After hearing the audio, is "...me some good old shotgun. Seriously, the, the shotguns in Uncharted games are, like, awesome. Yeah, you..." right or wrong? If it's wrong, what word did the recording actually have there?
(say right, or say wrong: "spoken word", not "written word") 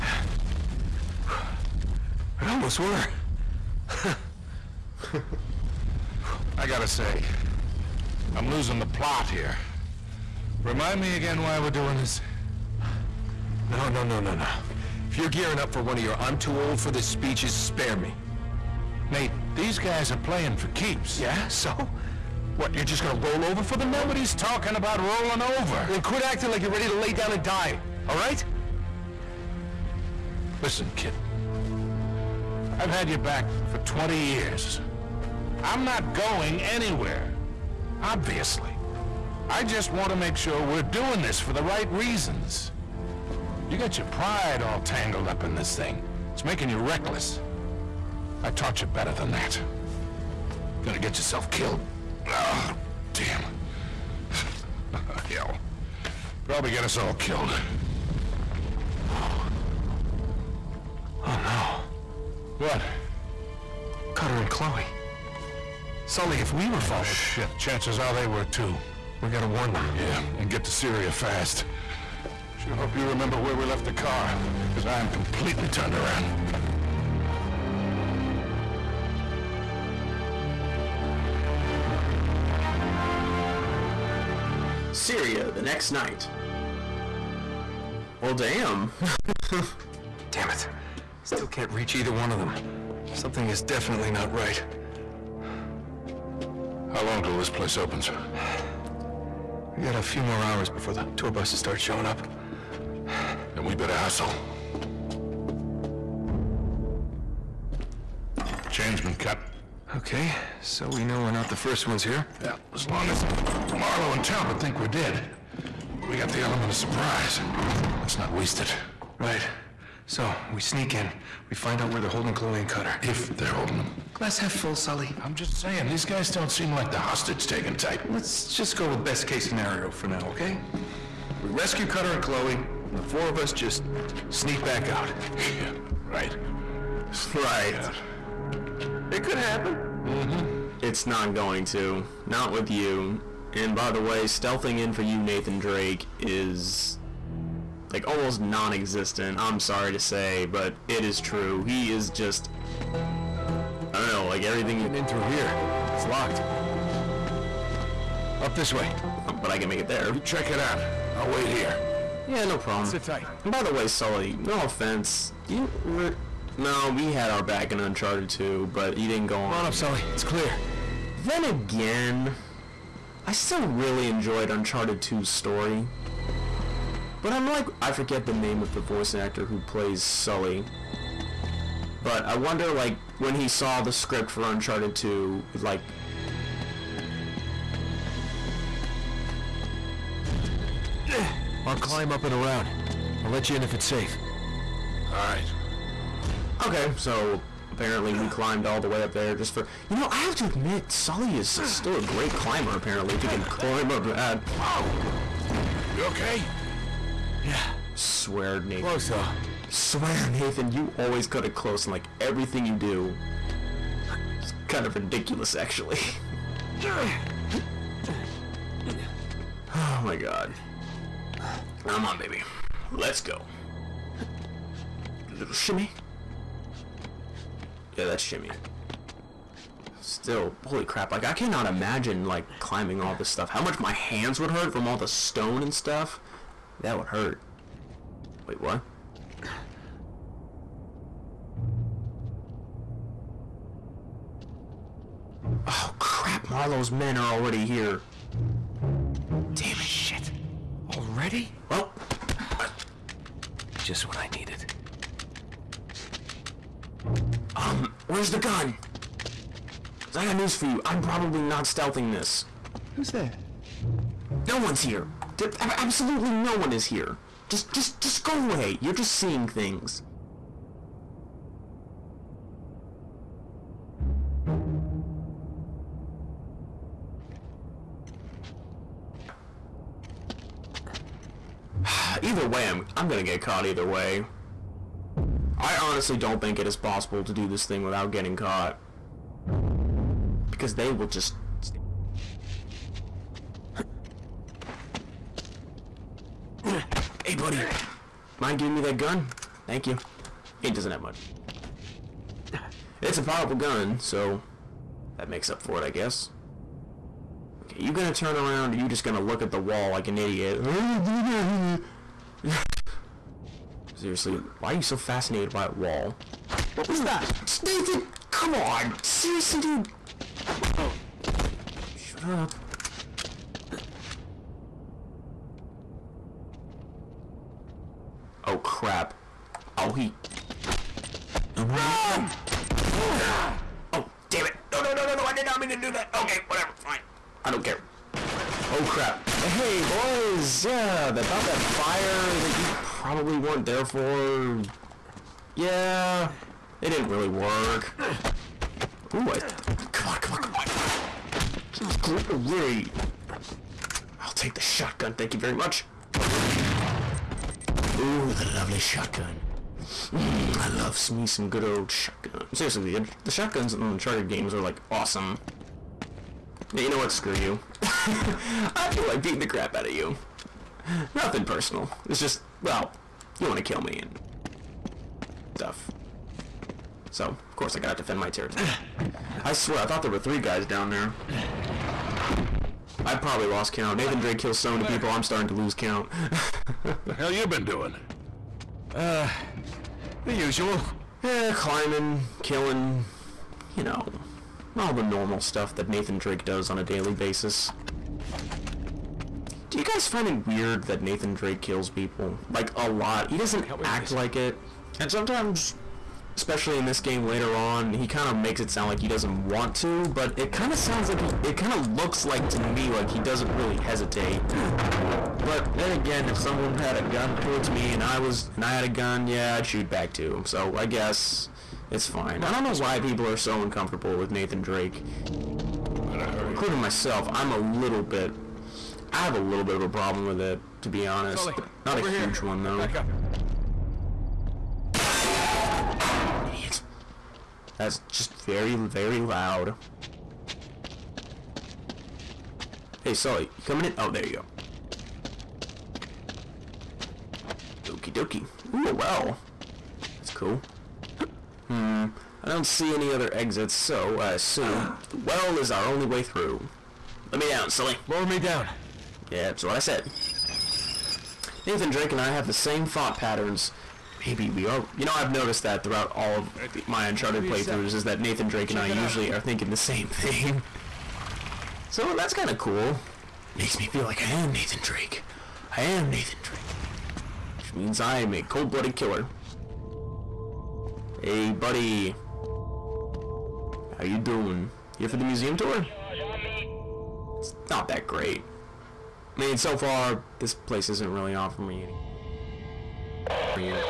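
right.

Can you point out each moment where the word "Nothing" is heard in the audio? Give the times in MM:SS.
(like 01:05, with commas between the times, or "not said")
06:11.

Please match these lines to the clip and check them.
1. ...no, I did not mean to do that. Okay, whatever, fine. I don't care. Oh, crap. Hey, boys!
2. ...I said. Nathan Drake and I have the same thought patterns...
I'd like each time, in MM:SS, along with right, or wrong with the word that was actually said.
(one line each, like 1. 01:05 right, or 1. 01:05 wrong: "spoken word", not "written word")
1. 05:35 right
2. 07:39 right.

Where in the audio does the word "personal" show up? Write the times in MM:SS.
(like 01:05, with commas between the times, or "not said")
06:11.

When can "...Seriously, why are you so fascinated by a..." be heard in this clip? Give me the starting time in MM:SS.
05:13.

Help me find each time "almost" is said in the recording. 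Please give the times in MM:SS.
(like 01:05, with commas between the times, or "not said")
00:02, 02:28.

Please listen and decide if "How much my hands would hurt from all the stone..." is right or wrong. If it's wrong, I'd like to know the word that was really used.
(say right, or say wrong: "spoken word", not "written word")
right.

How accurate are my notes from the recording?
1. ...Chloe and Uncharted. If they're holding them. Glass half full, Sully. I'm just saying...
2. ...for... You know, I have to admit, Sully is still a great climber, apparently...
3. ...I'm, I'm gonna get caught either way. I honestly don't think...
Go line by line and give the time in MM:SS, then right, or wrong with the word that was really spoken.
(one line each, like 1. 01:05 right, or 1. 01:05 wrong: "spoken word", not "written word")
1. 02:02 wrong: "Cutter", not "Uncharted"
2. 03:19 right
3. 04:42 right.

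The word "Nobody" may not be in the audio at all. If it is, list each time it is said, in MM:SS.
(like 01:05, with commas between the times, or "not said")
00:24.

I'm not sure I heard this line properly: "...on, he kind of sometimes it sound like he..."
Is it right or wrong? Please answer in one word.
wrong.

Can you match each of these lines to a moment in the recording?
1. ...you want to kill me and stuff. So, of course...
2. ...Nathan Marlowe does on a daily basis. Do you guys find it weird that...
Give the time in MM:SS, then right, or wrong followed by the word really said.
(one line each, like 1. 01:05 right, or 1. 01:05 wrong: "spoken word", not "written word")
1. 06:13 right
2. 06:35 wrong: "Drake", not "Marlowe".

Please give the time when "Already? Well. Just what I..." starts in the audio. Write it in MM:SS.
04:10.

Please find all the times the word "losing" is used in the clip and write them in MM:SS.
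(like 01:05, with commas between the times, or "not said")
00:08.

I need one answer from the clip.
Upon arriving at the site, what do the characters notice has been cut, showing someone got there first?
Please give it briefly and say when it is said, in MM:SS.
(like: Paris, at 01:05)
Chain, at 01:48.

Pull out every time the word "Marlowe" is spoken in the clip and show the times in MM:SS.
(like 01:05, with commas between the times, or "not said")
01:53, 04:06.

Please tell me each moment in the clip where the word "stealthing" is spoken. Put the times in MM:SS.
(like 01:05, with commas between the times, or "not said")
02:24, 04:21.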